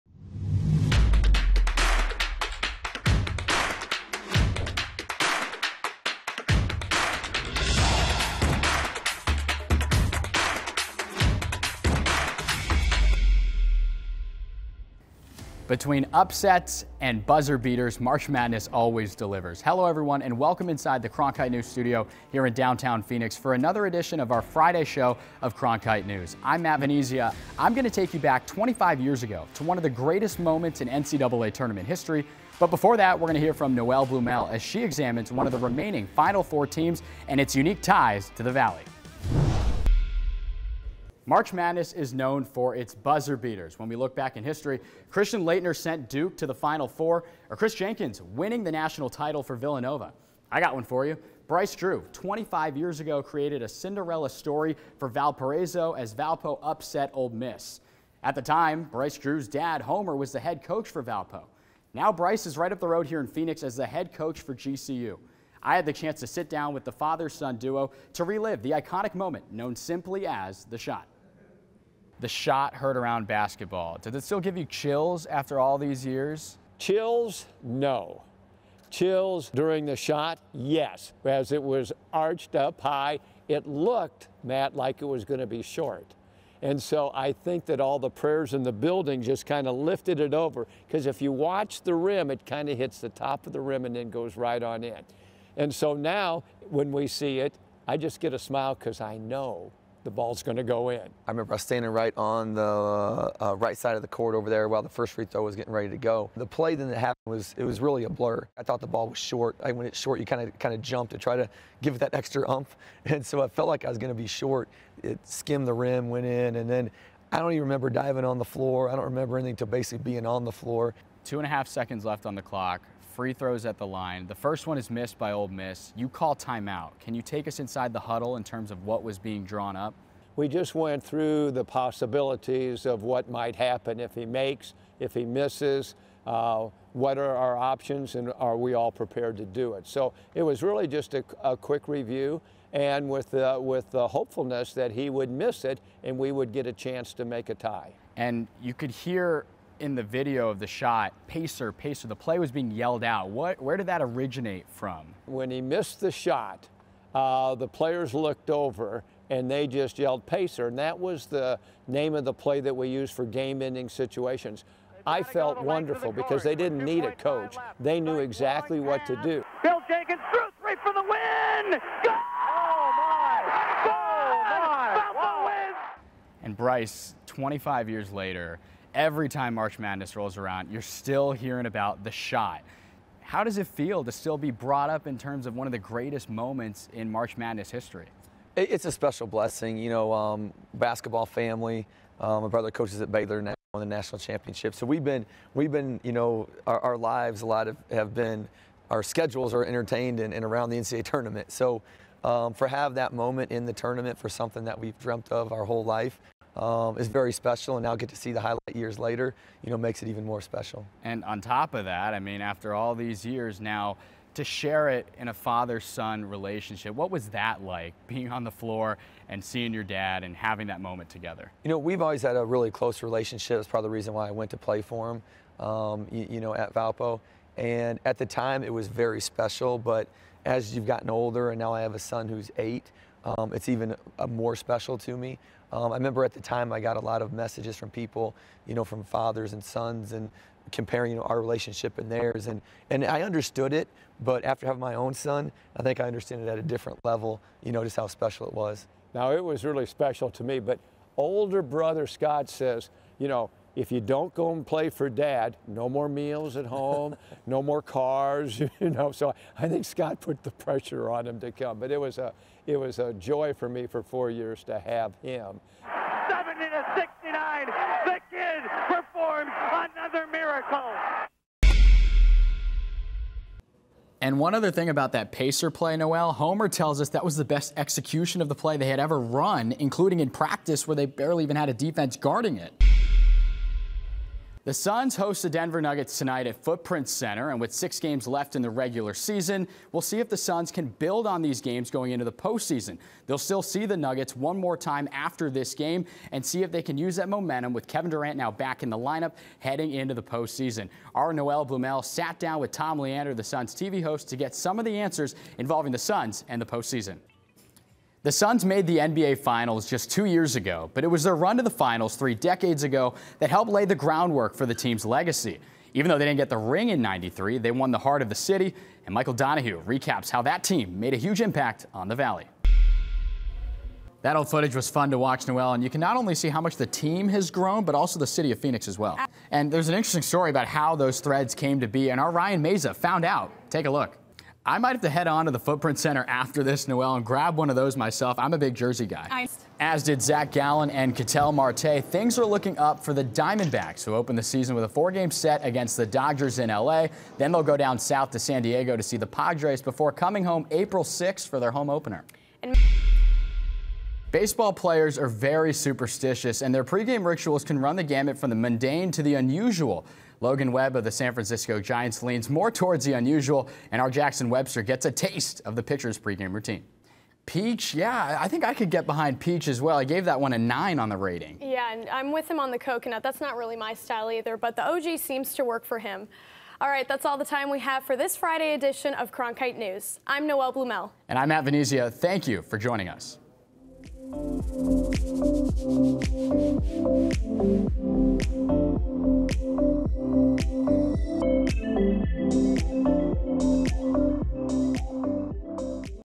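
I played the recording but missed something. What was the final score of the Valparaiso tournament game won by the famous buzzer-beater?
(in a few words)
70 to 69.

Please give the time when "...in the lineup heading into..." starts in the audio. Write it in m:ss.
4:58.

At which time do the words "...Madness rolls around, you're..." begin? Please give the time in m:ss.
2:59.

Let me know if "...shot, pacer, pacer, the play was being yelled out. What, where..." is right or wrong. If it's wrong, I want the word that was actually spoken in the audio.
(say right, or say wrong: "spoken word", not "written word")
right.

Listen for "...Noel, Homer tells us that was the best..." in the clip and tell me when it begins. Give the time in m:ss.
4:35.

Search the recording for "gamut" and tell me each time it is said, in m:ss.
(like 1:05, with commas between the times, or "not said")
5:58.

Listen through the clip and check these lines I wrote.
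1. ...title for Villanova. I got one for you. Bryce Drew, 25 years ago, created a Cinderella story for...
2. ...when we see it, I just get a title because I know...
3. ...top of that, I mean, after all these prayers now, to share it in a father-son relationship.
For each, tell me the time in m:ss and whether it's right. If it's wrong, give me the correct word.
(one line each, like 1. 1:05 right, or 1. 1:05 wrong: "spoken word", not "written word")
1. 0:49 right
2. 1:36 wrong: "smile", not "title"
3. 3:31 wrong: "years", not "prayers".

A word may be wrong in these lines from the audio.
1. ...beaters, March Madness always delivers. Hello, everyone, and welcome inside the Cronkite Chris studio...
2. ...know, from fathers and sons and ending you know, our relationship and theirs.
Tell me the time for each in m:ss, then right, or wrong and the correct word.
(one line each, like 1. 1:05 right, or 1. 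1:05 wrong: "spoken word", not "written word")
1. 0:17 wrong: "News", not "Chris"
2. 3:58 wrong: "comparing", not "ending".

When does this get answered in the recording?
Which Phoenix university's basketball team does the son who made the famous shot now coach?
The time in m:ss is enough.
1:04.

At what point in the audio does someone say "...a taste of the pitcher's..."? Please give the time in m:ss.
6:05.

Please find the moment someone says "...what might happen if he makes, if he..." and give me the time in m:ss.
2:13.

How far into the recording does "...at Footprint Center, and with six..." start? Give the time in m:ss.
4:46.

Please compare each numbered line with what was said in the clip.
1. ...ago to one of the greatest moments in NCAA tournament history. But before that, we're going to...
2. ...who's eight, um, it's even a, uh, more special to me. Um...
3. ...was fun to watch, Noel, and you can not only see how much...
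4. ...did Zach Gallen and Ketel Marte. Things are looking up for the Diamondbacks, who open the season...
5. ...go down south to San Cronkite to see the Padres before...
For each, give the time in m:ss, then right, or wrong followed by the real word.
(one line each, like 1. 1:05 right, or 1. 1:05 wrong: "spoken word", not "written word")
1. 0:29 right
2. 3:52 right
3. 5:24 right
4. 5:40 right
5. 5:47 wrong: "Diego", not "Cronkite".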